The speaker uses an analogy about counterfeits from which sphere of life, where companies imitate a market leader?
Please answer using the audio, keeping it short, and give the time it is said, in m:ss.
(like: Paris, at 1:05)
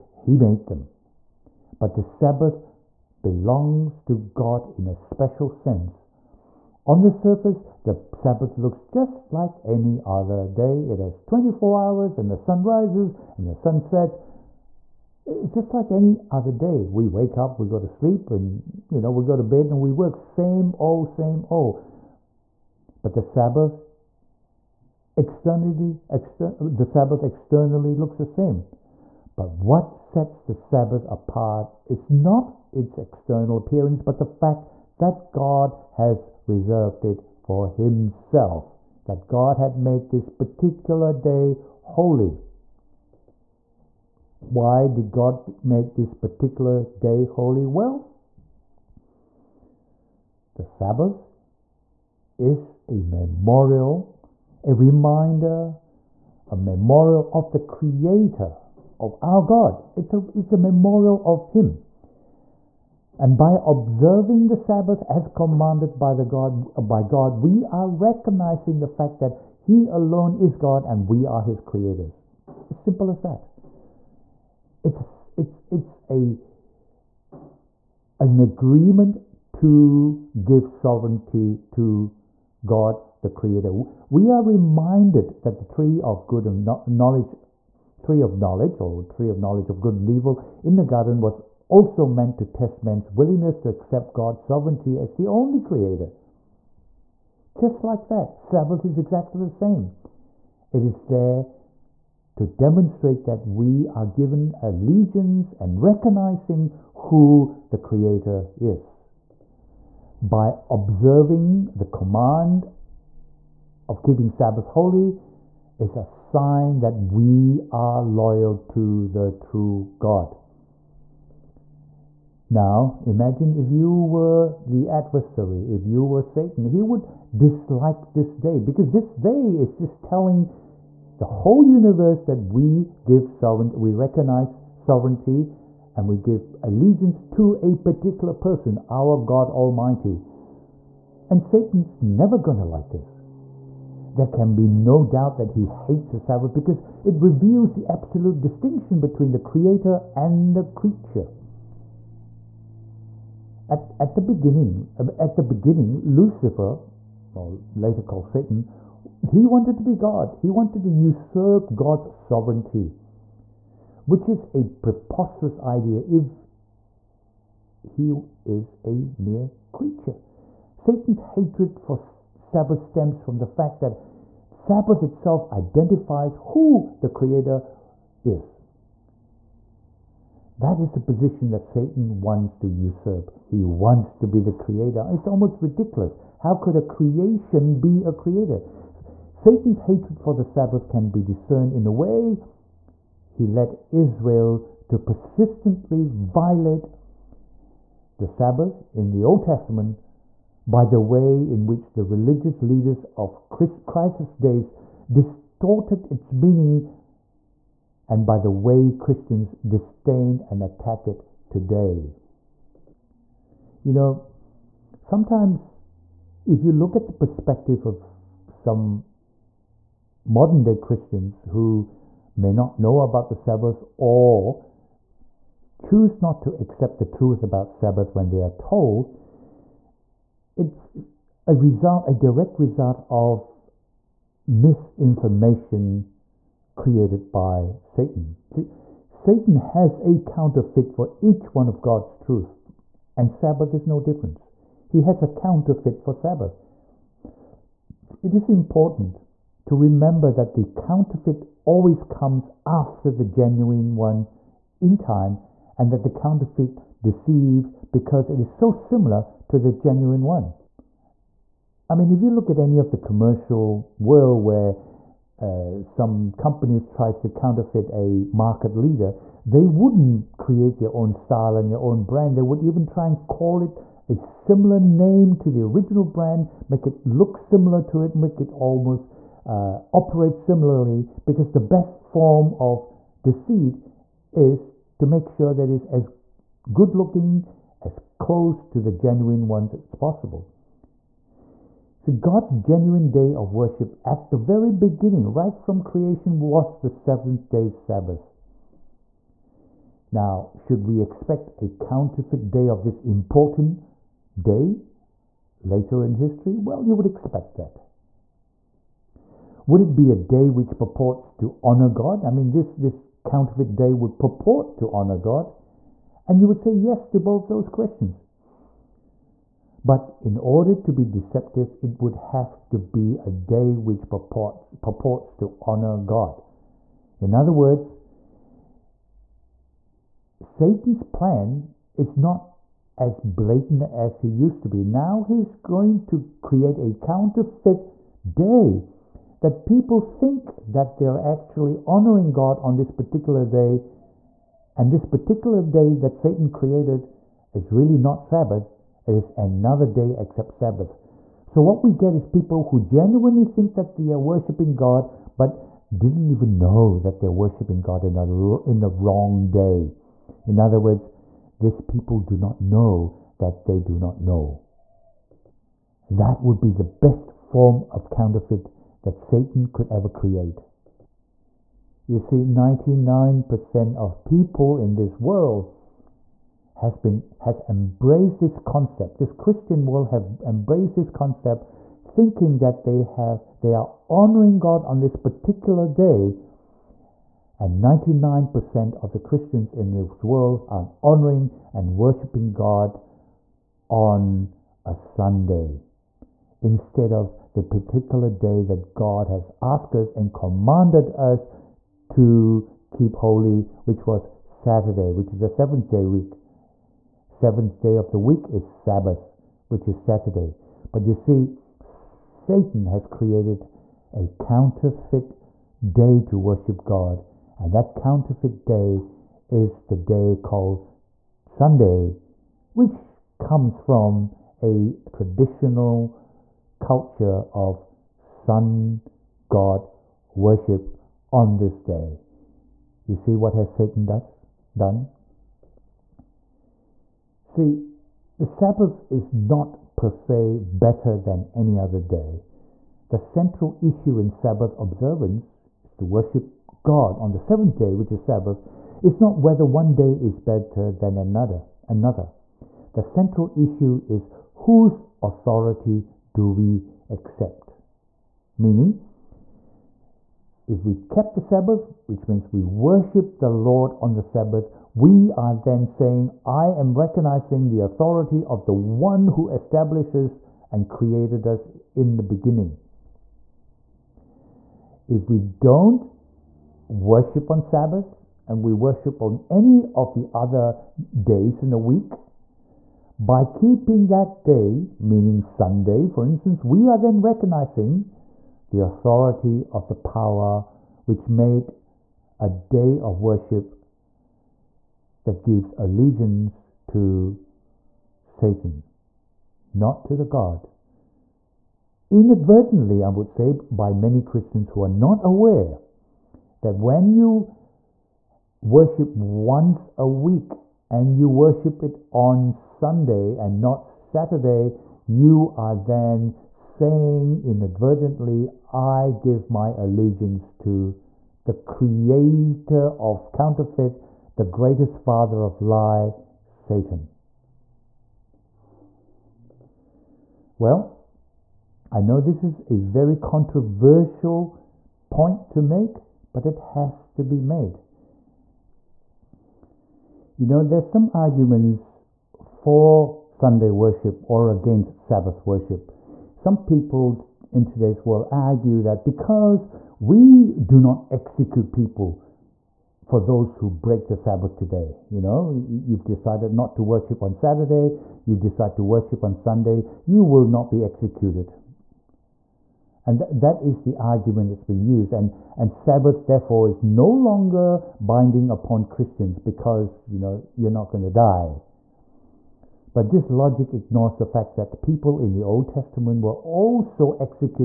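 Commercial world, at 4:22.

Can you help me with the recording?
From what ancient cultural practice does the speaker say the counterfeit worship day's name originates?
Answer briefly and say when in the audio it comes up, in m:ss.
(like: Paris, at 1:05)
Sun god worship, at 7:08.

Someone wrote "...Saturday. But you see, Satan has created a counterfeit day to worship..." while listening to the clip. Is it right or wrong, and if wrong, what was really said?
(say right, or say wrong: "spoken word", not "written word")
right.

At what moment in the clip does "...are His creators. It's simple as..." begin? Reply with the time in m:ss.
1:11.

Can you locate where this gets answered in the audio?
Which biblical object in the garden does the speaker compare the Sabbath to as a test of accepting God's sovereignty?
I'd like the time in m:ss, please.
1:29.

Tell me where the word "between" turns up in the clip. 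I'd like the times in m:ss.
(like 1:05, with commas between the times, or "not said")
2:28.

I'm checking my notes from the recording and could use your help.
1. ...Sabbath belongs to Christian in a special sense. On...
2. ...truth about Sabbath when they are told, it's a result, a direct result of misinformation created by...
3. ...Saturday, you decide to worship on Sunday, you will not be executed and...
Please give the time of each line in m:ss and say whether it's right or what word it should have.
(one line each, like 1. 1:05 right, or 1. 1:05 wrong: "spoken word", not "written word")
1. 0:02 wrong: "God", not "Christian"
2. 3:47 right
3. 9:17 right.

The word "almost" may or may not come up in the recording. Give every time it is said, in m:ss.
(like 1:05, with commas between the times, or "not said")
3:05, 4:38.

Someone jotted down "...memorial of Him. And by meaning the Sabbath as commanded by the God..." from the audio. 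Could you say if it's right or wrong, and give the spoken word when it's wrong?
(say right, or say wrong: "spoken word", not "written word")
wrong: "observing", not "meaning".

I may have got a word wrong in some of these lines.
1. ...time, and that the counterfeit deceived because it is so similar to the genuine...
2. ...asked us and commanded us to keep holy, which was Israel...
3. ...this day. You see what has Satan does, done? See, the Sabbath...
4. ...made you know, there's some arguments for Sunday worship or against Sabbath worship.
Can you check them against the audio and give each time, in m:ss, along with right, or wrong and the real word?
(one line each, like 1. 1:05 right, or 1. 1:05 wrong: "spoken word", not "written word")
1. 4:14 right
2. 6:39 wrong: "Saturday", not "Israel"
3. 7:11 right
4. 8:57 right.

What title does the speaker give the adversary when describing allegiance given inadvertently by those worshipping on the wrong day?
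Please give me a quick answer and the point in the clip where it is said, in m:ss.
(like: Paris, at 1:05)
Father of lie, at 8:44.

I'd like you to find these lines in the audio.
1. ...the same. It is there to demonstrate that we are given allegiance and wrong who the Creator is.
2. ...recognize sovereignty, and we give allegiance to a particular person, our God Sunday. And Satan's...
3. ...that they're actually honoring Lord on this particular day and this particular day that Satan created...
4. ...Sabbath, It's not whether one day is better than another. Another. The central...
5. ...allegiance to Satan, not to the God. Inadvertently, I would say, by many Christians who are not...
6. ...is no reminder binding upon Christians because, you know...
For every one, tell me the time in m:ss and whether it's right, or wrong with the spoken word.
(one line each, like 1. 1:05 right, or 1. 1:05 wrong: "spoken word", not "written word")
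1. 1:39 wrong: "recognizing", not "wrong"
2. 2:13 wrong: "Almighty", not "Sunday"
3. 5:40 wrong: "God", not "Lord"
4. 7:28 right
5. 8:15 right
6. 9:26 wrong: "longer", not "reminder".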